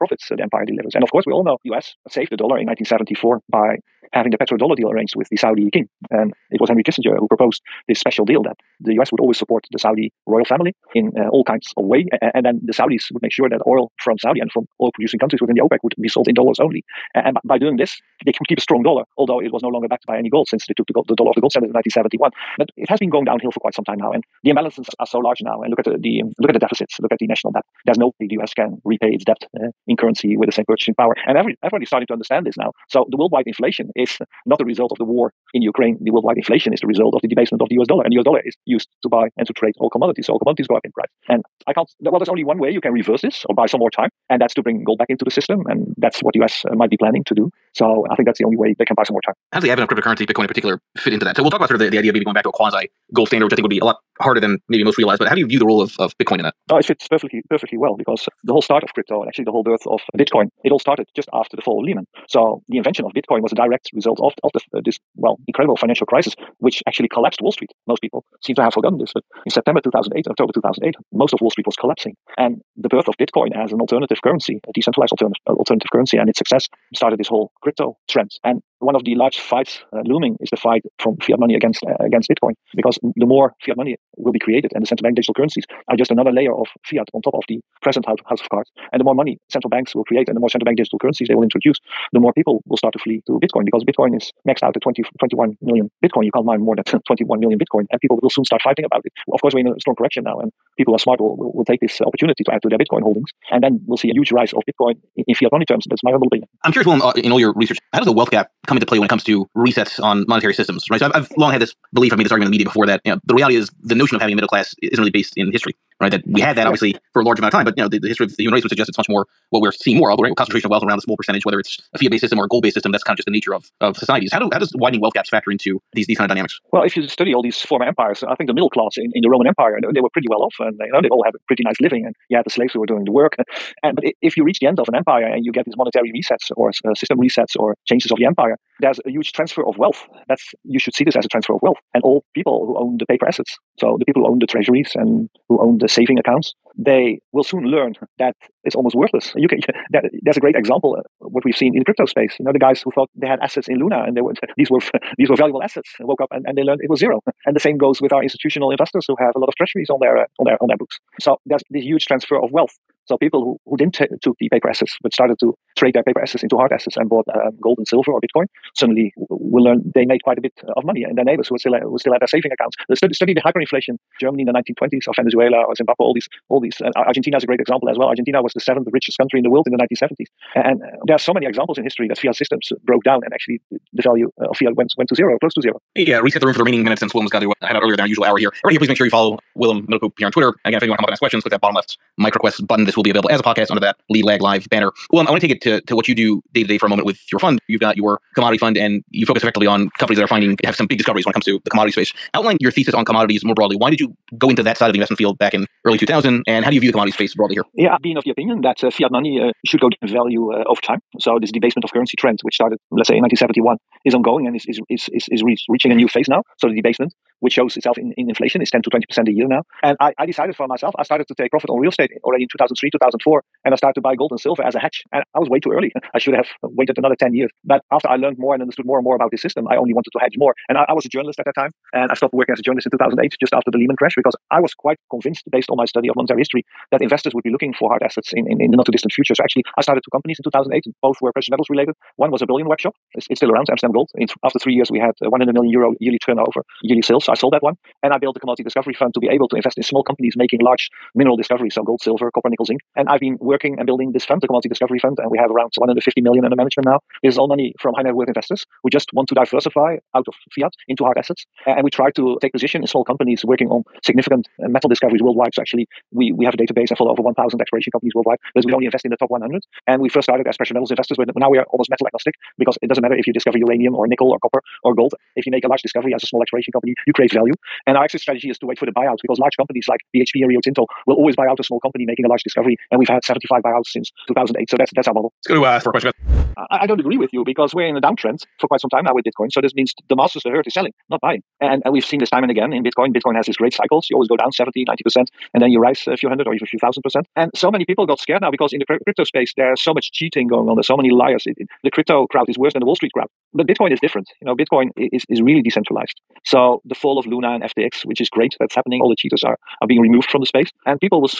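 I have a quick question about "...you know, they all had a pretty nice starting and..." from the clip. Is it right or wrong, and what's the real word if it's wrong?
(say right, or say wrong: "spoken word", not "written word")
wrong: "living", not "starting".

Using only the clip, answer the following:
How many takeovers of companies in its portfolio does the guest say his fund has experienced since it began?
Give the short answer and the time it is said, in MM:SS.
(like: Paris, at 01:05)
75, at 04:43.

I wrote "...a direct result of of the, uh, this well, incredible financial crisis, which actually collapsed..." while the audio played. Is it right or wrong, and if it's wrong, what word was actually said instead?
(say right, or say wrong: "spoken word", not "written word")
right.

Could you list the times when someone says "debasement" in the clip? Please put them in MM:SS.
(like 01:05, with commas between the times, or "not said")
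00:37, 03:31, 03:36.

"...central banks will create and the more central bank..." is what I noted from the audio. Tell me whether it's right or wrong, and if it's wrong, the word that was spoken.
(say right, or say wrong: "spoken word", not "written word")
right.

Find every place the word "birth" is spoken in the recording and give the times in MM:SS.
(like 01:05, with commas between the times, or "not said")
00:59, 01:12.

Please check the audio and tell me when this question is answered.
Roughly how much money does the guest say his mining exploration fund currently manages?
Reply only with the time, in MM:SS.
04:15.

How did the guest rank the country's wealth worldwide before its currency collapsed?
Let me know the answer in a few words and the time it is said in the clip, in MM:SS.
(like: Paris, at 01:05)
7th richest, at 02:58.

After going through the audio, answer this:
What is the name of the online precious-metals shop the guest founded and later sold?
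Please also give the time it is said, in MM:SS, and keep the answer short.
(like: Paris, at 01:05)
Amsterdam Gold, at 04:03.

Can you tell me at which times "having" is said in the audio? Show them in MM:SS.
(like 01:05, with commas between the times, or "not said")
00:04, 01:54.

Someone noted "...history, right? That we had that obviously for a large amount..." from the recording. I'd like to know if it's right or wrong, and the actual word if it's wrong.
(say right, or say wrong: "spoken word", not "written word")
right.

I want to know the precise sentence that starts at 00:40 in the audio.
So all commodities go up in price.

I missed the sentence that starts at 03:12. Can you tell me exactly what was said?
This will be available as a podcast under that lead lag live banner.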